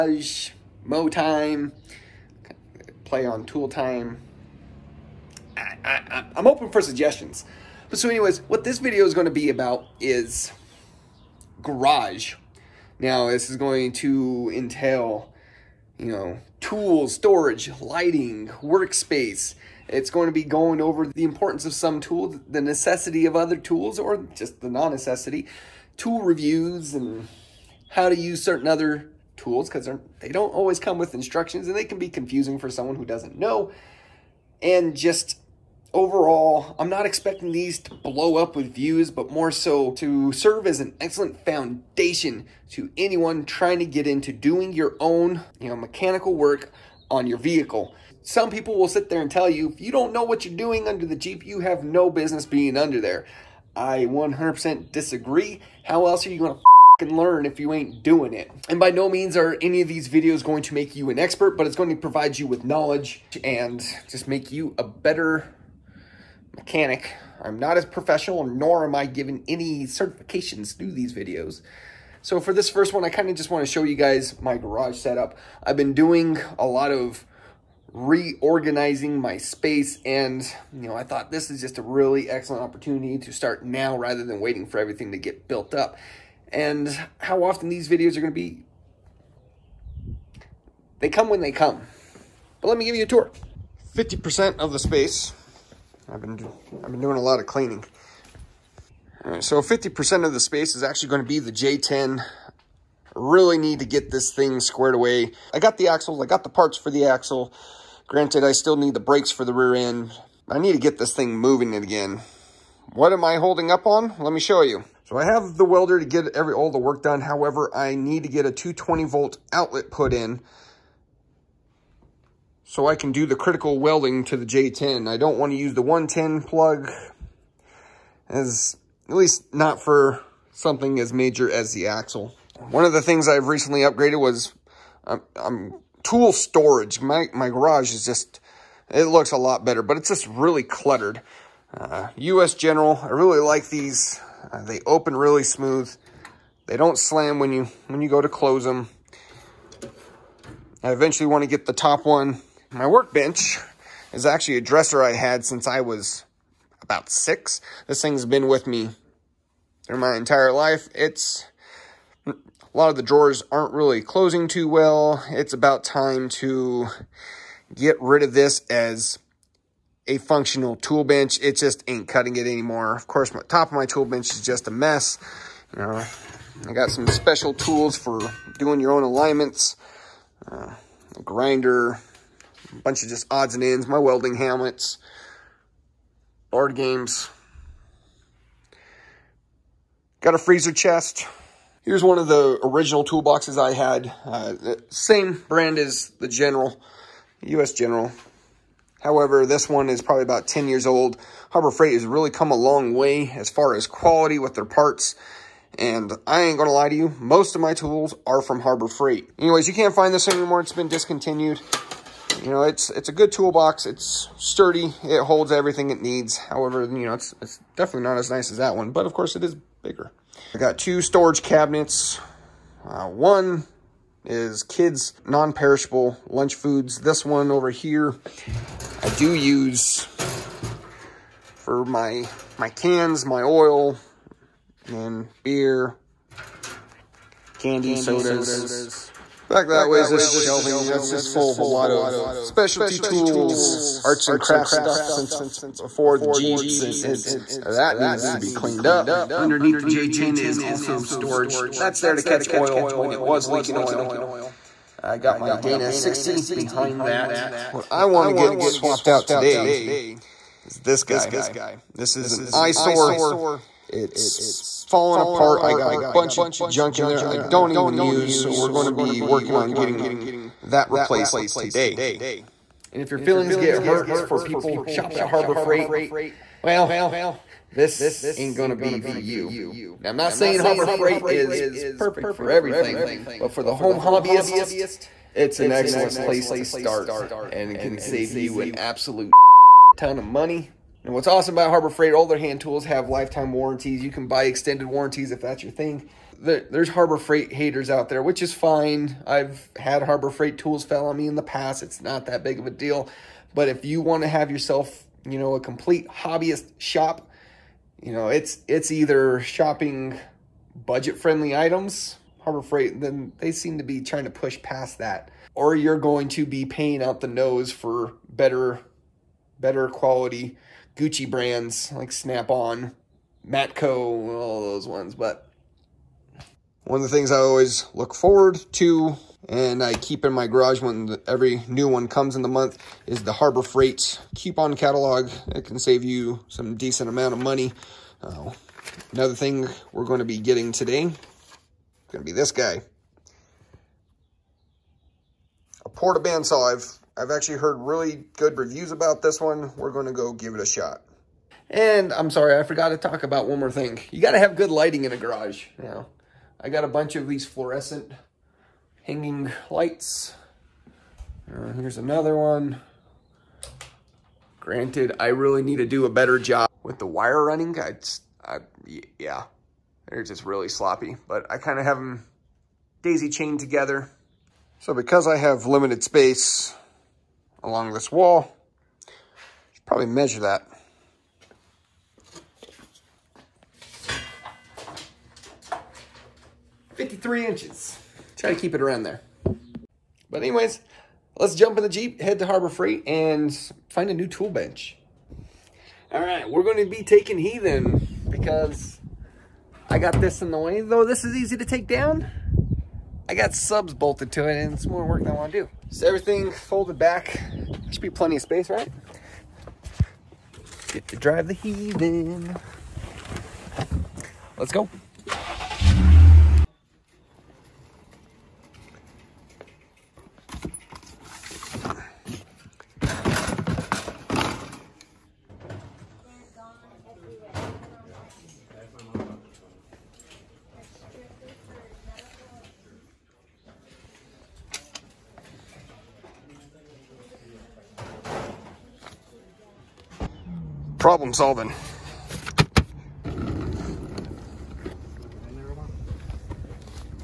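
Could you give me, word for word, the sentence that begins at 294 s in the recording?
You can buy extended warranties if that's your thing.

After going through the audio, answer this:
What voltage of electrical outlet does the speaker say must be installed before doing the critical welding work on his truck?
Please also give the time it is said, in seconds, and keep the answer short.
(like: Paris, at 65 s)
220 volt, at 118 s.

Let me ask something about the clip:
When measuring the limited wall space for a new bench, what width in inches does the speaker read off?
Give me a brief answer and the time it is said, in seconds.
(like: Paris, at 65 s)
53 inches, at 386 s.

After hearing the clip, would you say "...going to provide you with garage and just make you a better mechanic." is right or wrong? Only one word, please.
wrong.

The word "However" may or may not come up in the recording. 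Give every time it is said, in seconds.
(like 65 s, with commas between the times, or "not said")
117 s, 199 s, 216 s.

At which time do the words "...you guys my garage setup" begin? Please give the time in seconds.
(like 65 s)
73 s.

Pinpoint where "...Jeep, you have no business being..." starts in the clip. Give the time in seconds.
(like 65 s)
51 s.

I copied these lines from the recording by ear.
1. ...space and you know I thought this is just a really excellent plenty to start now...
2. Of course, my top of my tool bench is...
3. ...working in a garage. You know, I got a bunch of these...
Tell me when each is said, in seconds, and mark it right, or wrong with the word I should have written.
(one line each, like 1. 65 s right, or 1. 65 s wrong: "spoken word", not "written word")
1. 79 s wrong: "opportunity", not "plenty"
2. 172 s right
3. 354 s wrong: "lighting", not "working".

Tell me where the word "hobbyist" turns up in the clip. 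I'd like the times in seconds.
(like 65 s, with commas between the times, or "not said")
283 s, 306 s.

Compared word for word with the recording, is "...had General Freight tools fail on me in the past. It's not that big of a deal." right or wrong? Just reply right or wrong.
wrong.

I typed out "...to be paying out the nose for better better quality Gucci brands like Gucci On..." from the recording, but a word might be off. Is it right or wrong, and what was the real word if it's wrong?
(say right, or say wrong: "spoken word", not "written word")
wrong: "Snap", not "Gucci".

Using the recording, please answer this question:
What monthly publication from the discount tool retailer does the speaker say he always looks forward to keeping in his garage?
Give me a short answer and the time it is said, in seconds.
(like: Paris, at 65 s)
Coupon catalog, at 334 s.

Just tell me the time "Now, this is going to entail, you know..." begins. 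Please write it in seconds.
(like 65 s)
12 s.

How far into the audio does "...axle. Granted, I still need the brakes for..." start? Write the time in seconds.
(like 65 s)
107 s.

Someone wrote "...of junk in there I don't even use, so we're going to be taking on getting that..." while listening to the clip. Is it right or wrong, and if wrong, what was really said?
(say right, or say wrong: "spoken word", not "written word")
wrong: "working", not "taking".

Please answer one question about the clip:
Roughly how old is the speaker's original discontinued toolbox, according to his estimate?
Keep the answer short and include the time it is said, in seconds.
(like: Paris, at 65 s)
10 years, at 200 s.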